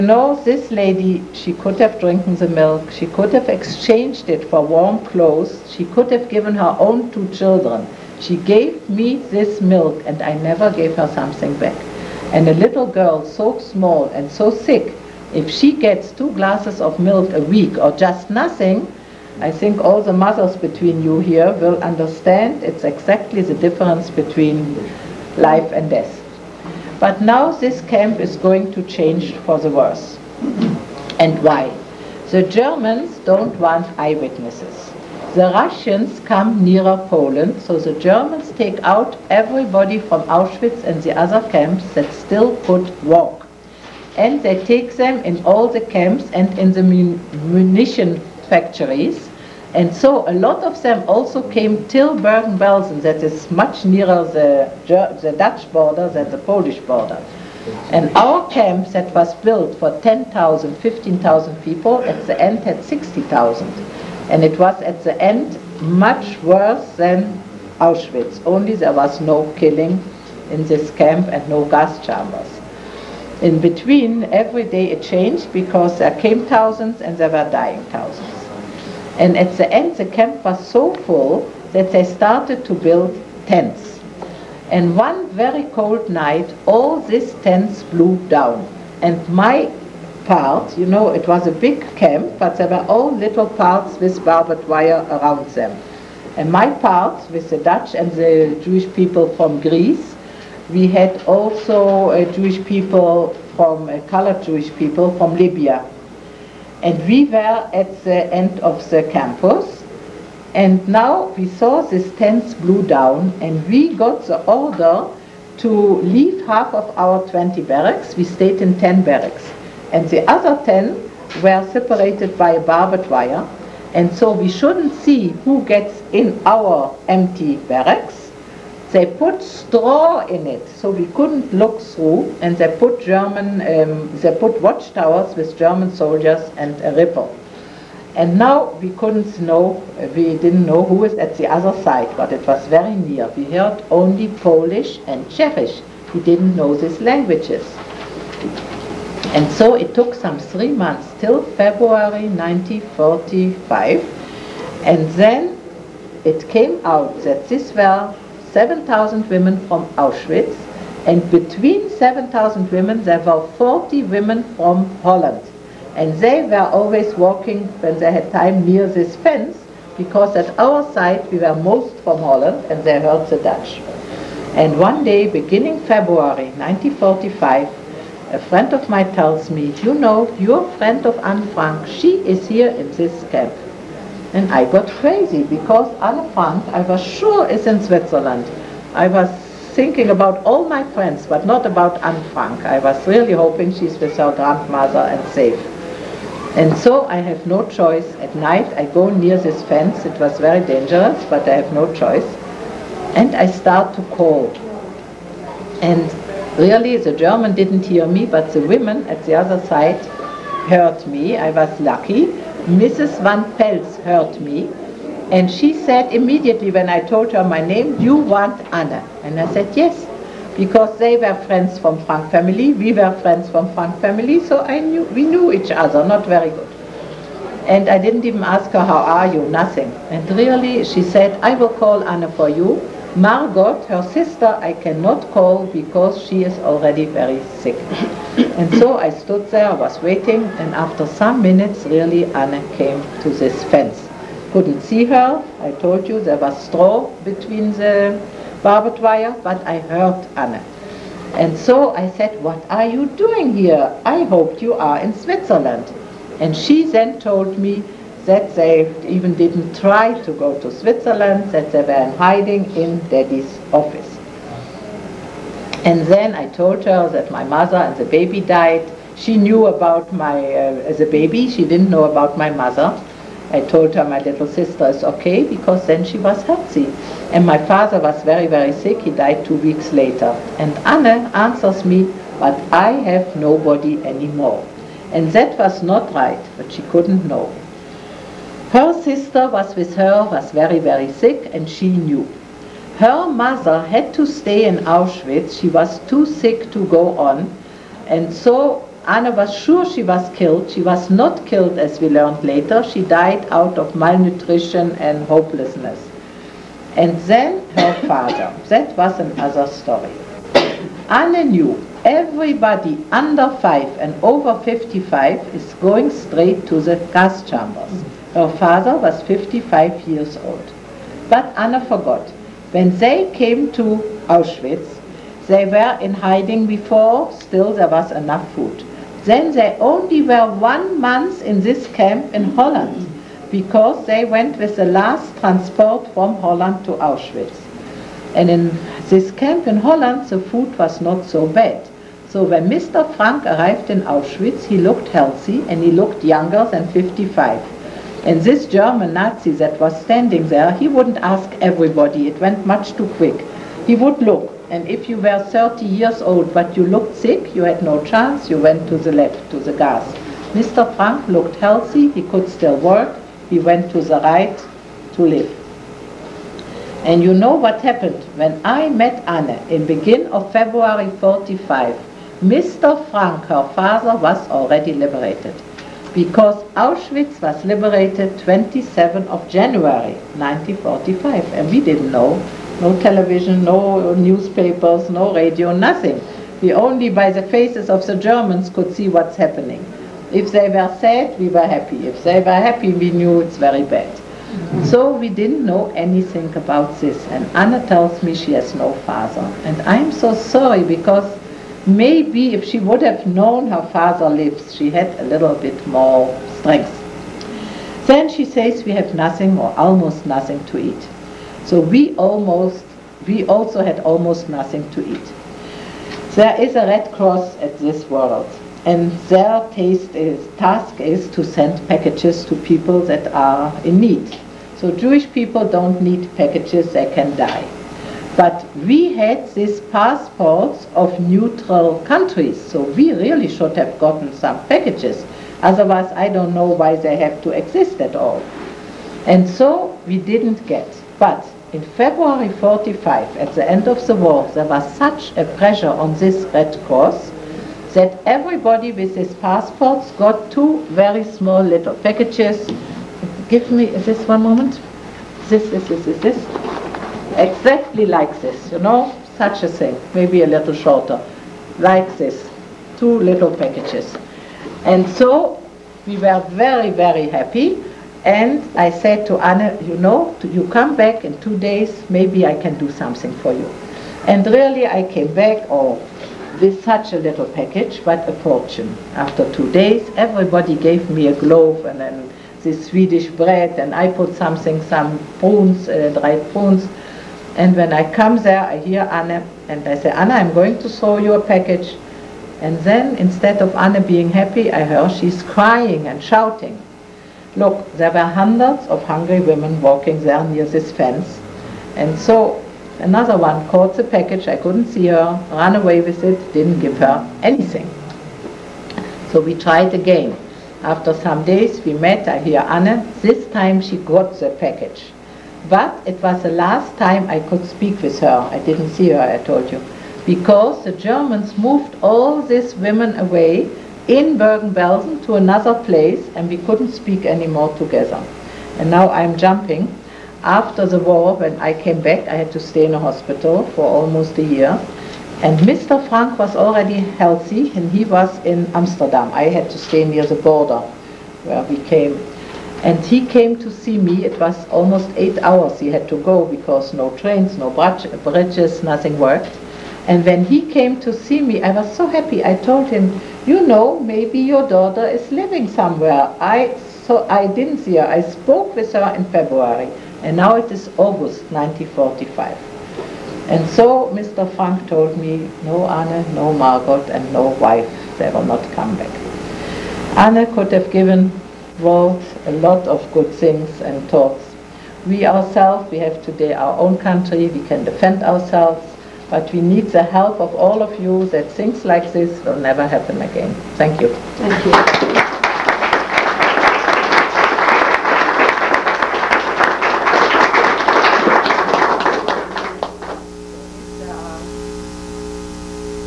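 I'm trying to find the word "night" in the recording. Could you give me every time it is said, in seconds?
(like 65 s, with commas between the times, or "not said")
86 s, 198 s.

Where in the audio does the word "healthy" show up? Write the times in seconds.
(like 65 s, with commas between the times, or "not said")
276 s, 345 s, 361 s, 537 s.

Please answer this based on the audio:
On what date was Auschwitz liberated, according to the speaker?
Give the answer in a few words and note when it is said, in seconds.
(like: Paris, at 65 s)
27 January 1945, at 378 s.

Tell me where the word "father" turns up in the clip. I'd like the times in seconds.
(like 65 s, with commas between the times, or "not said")
277 s, 308 s, 318 s, 373 s, 399 s, 403 s.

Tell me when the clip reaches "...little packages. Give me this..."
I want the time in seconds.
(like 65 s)
451 s.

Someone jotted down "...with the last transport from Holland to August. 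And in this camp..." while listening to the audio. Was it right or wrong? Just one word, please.
wrong.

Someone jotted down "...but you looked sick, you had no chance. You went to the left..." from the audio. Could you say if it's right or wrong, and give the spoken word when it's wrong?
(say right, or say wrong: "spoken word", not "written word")
right.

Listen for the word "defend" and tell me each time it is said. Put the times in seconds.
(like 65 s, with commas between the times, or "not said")
577 s.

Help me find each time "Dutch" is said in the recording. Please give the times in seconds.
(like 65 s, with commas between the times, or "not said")
55 s, 97 s, 173 s.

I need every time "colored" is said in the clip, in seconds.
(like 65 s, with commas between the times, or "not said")
104 s.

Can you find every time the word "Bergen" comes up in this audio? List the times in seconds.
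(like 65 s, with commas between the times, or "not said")
52 s, 524 s.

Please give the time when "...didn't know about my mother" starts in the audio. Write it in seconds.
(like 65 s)
271 s.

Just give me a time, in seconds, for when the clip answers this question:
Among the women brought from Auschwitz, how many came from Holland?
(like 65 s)
163 s.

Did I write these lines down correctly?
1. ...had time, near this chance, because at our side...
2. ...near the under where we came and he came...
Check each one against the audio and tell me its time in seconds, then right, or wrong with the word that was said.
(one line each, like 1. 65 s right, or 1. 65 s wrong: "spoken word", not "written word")
1. 168 s wrong: "fence", not "chance"
2. 540 s wrong: "border", not "under".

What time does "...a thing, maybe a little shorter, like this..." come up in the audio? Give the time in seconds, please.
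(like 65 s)
459 s.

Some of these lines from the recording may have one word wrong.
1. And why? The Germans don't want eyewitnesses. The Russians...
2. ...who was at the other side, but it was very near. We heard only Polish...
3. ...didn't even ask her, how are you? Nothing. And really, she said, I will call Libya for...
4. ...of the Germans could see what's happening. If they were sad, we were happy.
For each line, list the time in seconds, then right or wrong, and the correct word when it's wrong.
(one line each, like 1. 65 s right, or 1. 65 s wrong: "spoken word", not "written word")
1. 31 s right
2. 140 s right
3. 227 s wrong: "Anna", not "Libya"
4. 387 s right.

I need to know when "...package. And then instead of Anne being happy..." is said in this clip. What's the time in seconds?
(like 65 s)
491 s.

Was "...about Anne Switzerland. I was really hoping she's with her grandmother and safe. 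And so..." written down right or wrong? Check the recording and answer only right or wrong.
wrong.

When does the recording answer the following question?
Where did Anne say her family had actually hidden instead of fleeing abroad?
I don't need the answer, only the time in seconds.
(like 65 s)
263 s.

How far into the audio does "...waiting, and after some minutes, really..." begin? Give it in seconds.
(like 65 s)
239 s.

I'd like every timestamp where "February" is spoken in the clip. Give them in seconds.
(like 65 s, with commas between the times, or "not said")
151 s, 175 s, 370 s, 441 s, 559 s.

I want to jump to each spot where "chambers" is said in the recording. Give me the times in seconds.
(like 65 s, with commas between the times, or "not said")
72 s, 317 s.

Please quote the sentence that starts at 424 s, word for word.
So Jewish people don't need packages, they can die.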